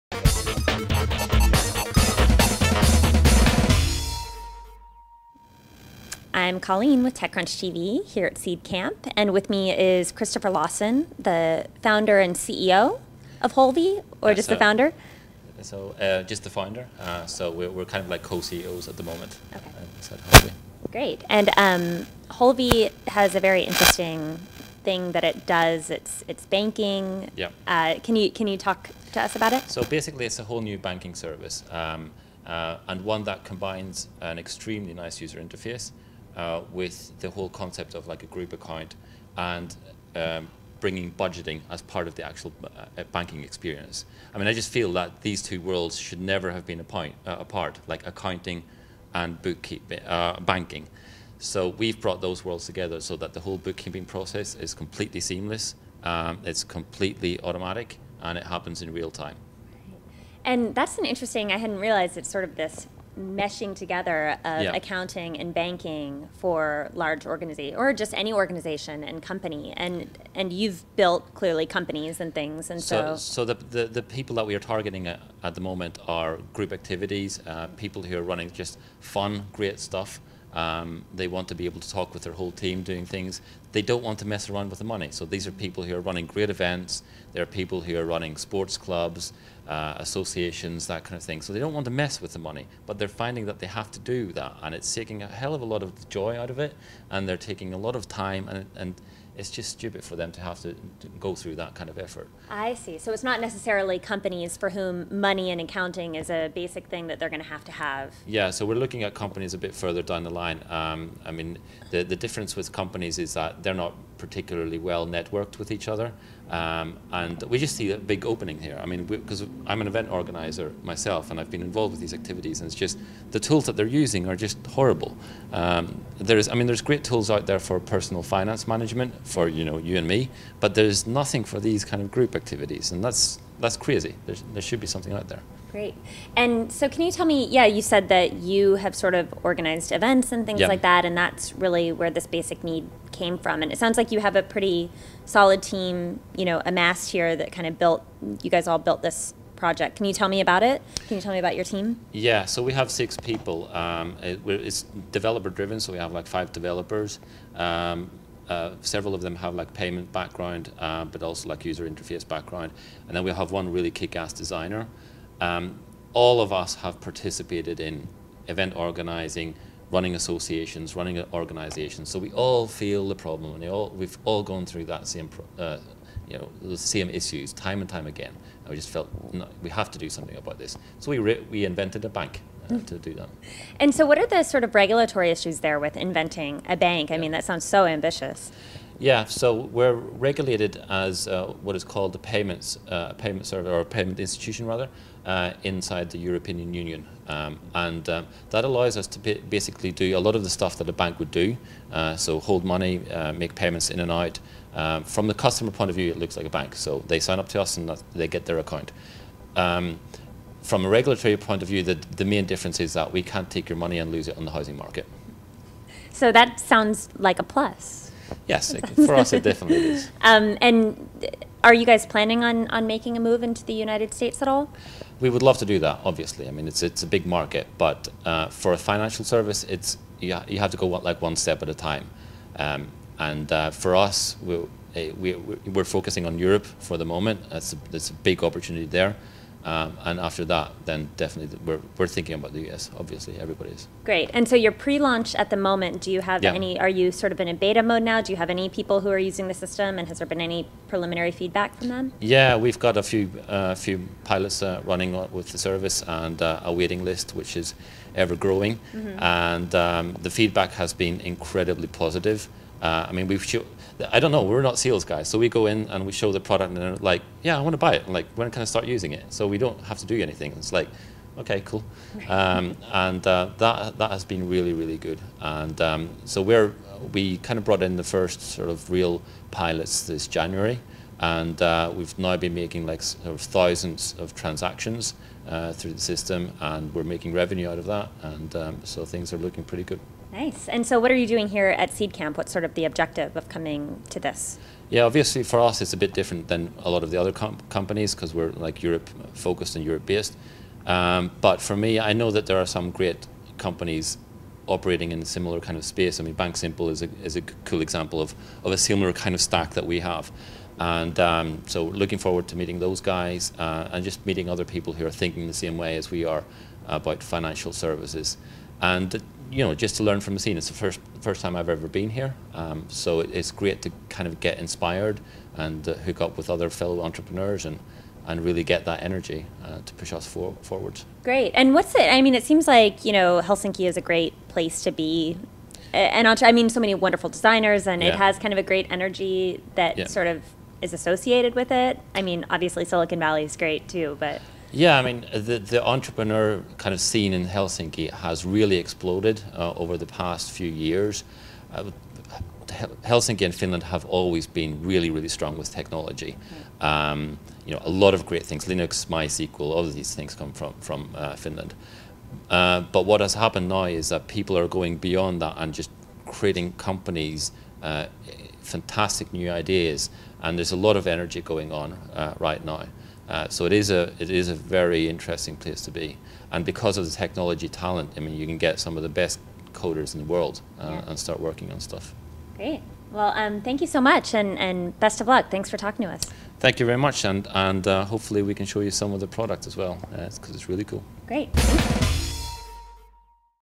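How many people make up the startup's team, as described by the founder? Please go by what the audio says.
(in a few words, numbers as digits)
6.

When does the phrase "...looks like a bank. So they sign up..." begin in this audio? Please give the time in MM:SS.
03:26.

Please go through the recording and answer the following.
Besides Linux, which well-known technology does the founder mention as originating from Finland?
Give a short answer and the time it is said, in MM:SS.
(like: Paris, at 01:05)
MySQL, at 05:59.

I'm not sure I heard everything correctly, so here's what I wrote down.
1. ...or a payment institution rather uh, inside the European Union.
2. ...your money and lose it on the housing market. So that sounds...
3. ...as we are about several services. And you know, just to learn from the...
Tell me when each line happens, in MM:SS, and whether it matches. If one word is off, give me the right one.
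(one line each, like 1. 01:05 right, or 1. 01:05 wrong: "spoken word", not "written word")
1. 03:13 right
2. 03:33 right
3. 05:15 wrong: "financial", not "several".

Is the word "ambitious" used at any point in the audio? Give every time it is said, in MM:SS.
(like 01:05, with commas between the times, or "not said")
03:07.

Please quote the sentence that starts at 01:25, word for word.
So these are people who are running great events.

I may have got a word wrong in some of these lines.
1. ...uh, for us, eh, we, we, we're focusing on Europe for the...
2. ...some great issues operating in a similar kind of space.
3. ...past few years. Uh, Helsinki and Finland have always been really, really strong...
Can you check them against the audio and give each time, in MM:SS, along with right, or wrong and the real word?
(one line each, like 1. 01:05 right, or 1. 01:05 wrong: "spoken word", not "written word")
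1. 03:53 right
2. 05:02 wrong: "companies", not "issues"
3. 05:50 right.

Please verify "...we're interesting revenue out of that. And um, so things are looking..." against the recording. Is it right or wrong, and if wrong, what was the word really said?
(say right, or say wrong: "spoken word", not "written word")
wrong: "making", not "interesting".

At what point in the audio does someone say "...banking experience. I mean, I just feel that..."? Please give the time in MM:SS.
00:43.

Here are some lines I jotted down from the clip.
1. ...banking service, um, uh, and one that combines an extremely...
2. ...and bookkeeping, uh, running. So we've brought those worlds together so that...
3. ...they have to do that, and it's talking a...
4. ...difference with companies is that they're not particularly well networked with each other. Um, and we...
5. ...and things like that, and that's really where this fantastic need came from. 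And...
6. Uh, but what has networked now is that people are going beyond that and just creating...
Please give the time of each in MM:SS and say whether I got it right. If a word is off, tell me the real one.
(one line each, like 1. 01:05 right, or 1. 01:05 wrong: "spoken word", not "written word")
1. 00:30 right
2. 00:49 wrong: "banking", not "running"
3. 01:33 wrong: "taking", not "talking"
4. 01:52 right
5. 02:20 wrong: "basic", not "fantastic"
6. 06:02 wrong: "happened", not "networked".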